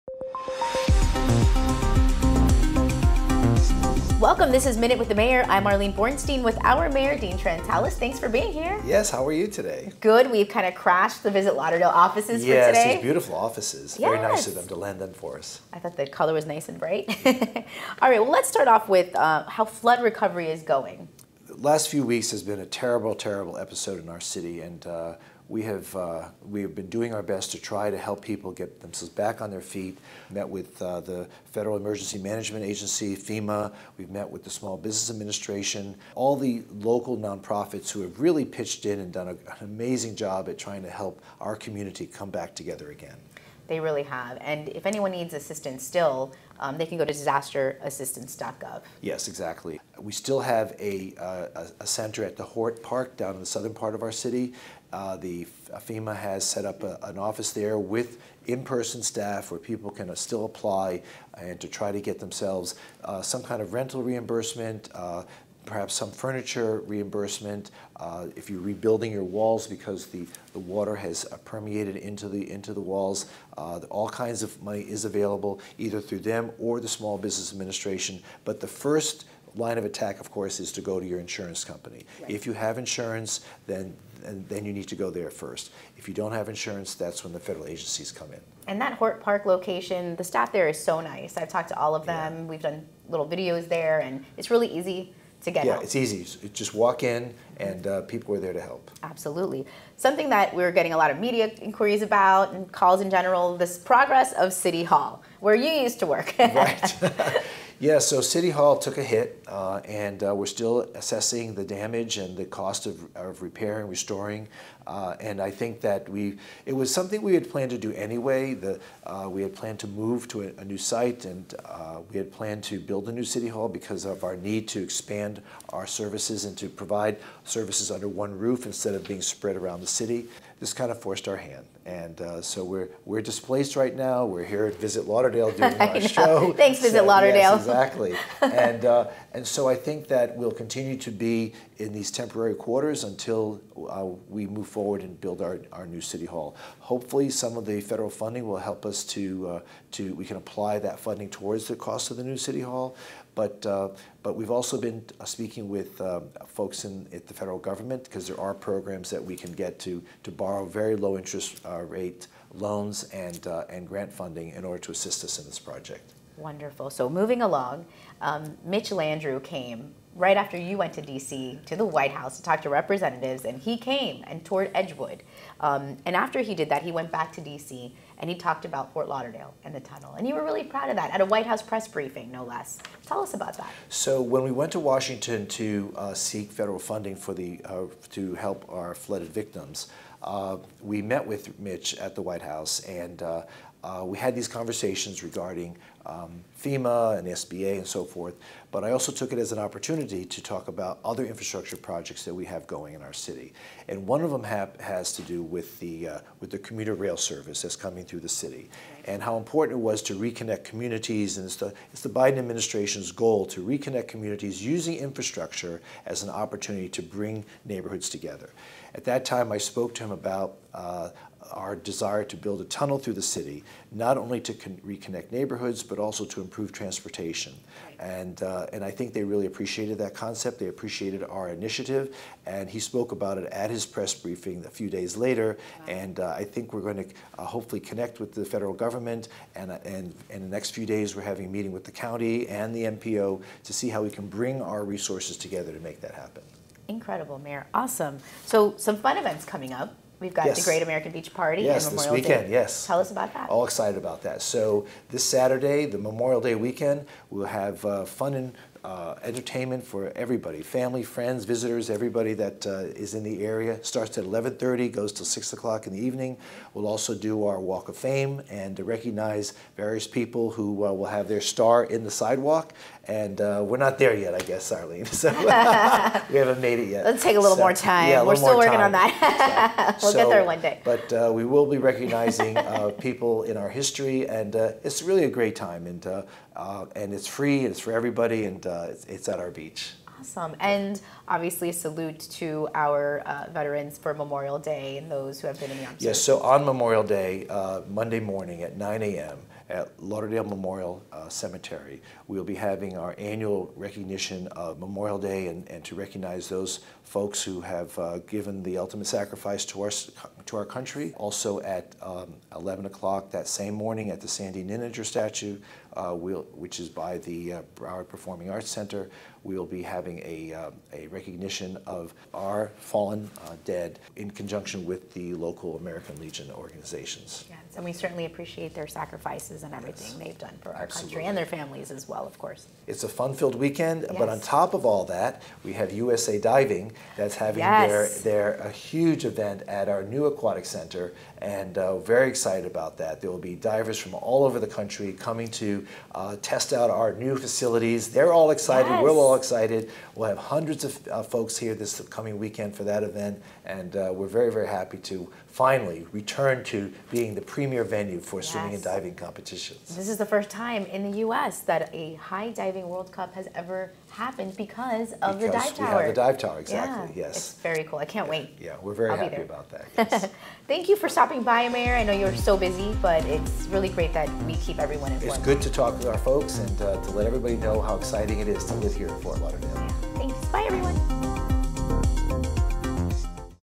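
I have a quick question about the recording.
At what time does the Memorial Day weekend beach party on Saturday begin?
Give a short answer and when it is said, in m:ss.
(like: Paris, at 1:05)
11:30, at 4:24.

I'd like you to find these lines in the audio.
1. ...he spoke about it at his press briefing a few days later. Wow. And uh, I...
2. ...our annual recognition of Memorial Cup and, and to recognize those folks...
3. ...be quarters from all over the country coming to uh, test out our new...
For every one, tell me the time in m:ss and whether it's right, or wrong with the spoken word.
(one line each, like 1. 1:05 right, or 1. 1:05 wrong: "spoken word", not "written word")
1. 3:52 right
2. 5:02 wrong: "Day", not "Cup"
3. 5:43 wrong: "divers", not "quarters".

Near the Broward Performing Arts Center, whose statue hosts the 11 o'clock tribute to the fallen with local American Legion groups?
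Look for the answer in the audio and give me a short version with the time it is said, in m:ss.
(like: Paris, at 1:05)
Sandy Nininger, at 5:14.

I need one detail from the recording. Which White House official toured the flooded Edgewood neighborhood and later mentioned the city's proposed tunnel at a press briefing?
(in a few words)
Mitch Landrieu.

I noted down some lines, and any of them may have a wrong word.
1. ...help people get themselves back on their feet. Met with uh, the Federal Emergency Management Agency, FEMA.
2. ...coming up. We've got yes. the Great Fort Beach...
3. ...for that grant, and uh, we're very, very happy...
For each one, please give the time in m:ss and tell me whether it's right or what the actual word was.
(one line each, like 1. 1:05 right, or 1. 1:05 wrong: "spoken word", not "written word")
1. 0:27 right
2. 4:09 wrong: "American", not "Fort"
3. 5:52 wrong: "event", not "grant".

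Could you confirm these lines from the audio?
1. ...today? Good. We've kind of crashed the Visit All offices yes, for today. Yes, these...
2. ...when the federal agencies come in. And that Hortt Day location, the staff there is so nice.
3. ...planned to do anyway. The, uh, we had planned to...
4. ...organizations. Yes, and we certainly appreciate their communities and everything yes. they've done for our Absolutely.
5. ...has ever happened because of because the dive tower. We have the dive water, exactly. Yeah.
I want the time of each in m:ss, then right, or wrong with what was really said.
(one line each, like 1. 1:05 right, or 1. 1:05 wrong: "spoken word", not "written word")
1. 0:09 wrong: "Lauderdale", not "All"
2. 1:27 wrong: "Park", not "Day"
3. 1:57 right
4. 5:26 wrong: "sacrifices", not "communities"
5. 6:03 wrong: "tower", not "water".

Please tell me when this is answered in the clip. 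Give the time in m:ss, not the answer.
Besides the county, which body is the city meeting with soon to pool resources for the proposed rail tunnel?
4:02.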